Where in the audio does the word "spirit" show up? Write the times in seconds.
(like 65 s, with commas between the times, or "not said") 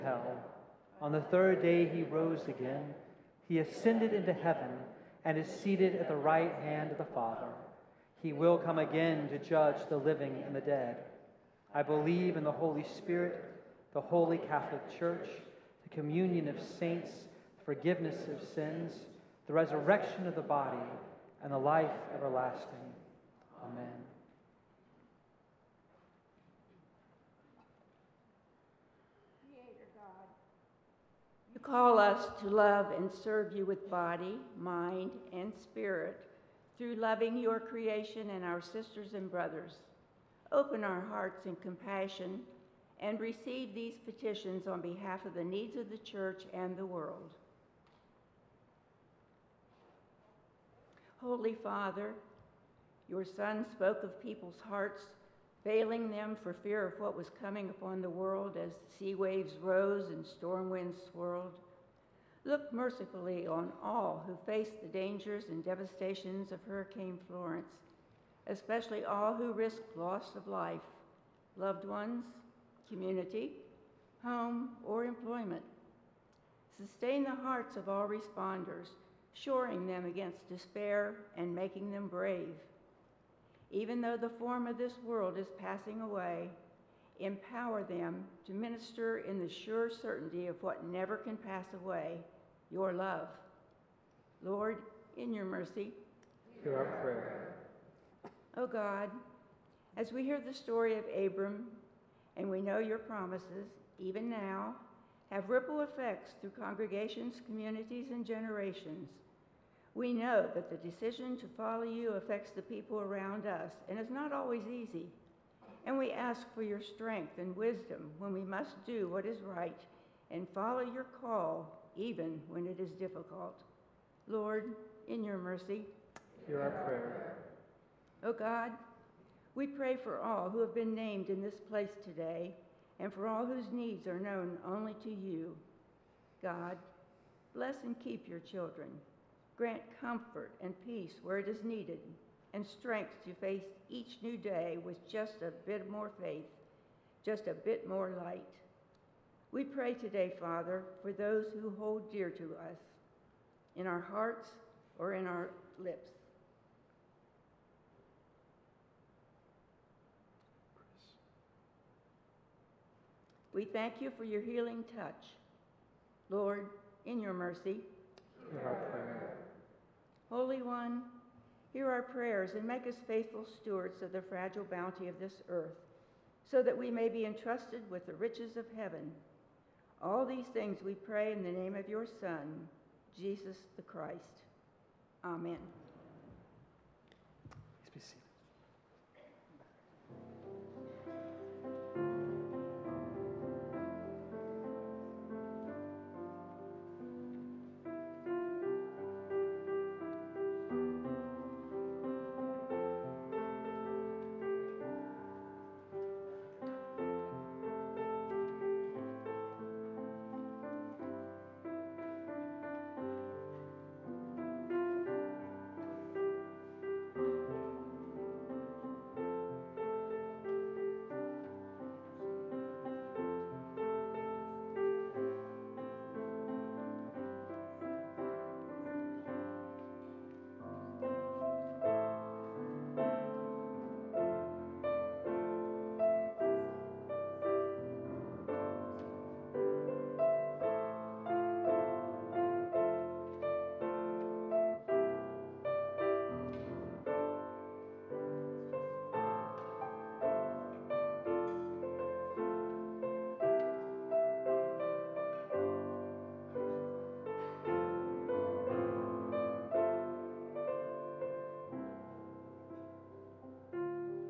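12 s, 35 s.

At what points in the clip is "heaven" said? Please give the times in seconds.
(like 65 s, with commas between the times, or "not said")
4 s, 178 s.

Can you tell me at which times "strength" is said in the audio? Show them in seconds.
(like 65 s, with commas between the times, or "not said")
116 s, 142 s.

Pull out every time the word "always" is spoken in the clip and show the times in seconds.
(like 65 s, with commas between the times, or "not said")
114 s.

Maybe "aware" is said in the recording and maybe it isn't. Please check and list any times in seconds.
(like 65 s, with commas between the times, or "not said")
not said.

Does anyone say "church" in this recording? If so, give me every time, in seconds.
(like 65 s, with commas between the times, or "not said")
14 s, 45 s.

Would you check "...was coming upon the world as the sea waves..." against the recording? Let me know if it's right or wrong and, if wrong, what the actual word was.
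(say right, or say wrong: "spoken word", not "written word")
right.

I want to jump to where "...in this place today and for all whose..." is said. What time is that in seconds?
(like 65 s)
131 s.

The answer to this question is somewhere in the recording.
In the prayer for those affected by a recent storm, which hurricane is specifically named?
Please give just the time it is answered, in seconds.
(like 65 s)
66 s.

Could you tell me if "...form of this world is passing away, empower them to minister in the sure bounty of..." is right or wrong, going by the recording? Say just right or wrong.
wrong.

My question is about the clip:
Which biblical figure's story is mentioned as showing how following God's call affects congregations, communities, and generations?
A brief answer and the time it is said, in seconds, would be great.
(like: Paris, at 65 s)
Abram, at 101 s.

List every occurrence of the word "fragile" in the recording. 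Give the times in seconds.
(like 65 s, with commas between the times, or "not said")
174 s.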